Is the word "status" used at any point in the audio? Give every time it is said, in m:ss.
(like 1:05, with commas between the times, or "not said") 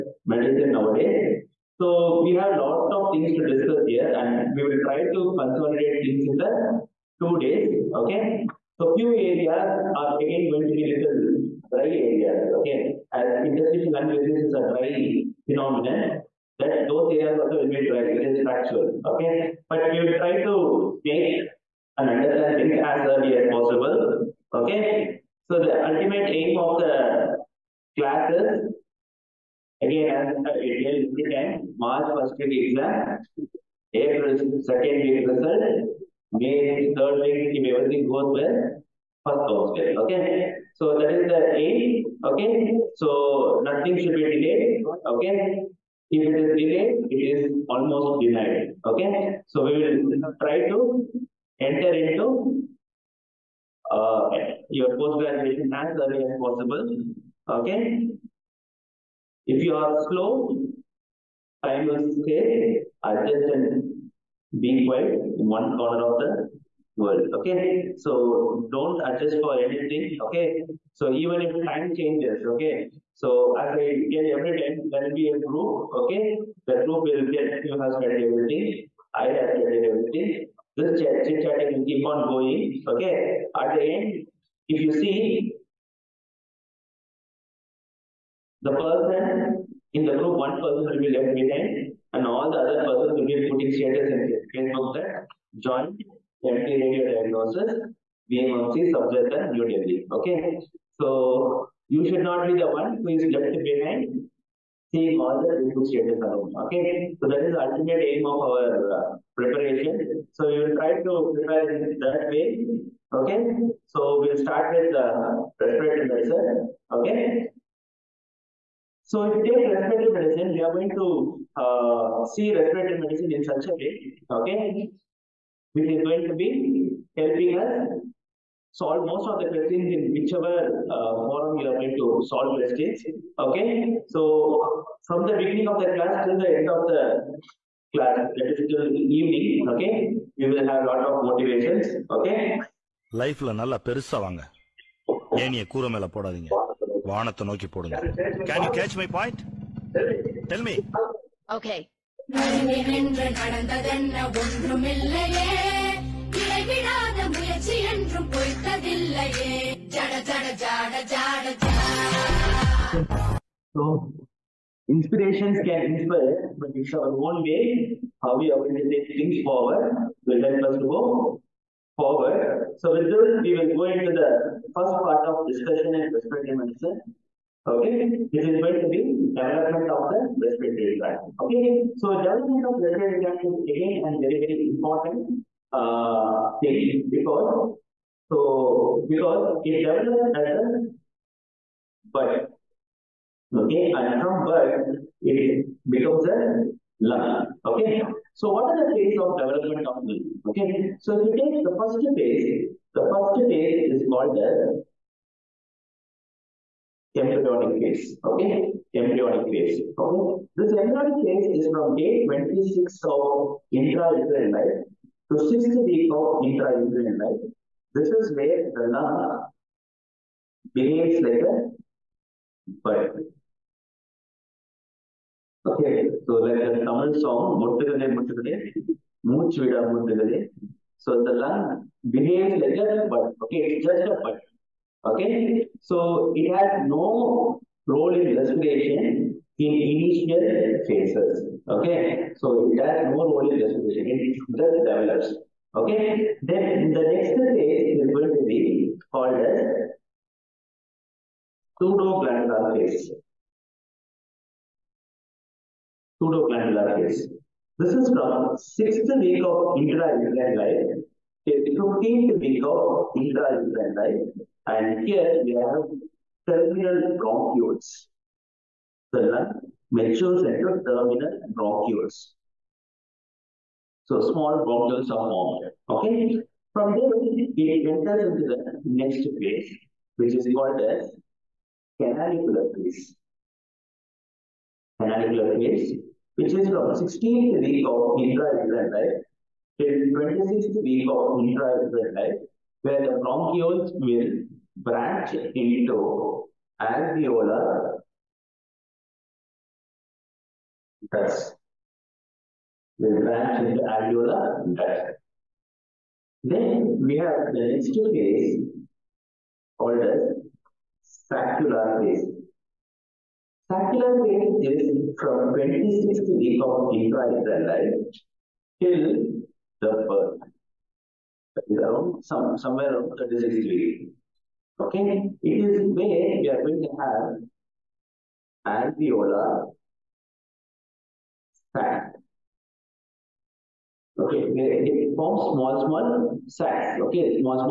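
1:33, 1:45.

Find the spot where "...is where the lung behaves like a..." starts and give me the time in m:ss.
3:38.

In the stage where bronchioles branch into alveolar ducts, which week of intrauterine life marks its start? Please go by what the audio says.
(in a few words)
16th week.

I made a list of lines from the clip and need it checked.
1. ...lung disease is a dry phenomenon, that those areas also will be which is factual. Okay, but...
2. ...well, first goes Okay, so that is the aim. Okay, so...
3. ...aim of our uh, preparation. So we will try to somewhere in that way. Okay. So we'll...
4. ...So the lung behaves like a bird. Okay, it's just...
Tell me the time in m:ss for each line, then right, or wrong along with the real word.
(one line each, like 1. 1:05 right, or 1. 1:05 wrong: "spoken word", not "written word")
1. 0:13 right
2. 0:38 right
3. 1:48 wrong: "prepare", not "somewhere"
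4. 3:50 right.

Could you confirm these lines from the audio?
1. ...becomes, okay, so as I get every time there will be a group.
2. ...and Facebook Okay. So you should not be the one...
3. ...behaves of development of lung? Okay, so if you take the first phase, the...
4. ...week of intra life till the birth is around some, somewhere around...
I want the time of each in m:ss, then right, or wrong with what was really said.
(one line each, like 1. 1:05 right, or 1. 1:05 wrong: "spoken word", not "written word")
1. 1:11 wrong: "changes", not "becomes"
2. 1:39 wrong: "New", not "Facebook"
3. 3:18 wrong: "phases", not "behaves"
4. 5:16 right.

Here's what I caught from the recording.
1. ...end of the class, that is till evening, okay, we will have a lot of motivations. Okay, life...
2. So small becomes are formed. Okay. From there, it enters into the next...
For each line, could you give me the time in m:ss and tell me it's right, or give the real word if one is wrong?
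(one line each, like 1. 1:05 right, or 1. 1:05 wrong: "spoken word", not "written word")
1. 2:16 right
2. 4:34 wrong: "bronchioles", not "becomes".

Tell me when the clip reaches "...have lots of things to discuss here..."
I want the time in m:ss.
0:02.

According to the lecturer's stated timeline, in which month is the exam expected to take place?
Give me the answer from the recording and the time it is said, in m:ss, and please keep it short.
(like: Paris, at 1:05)
March, at 0:31.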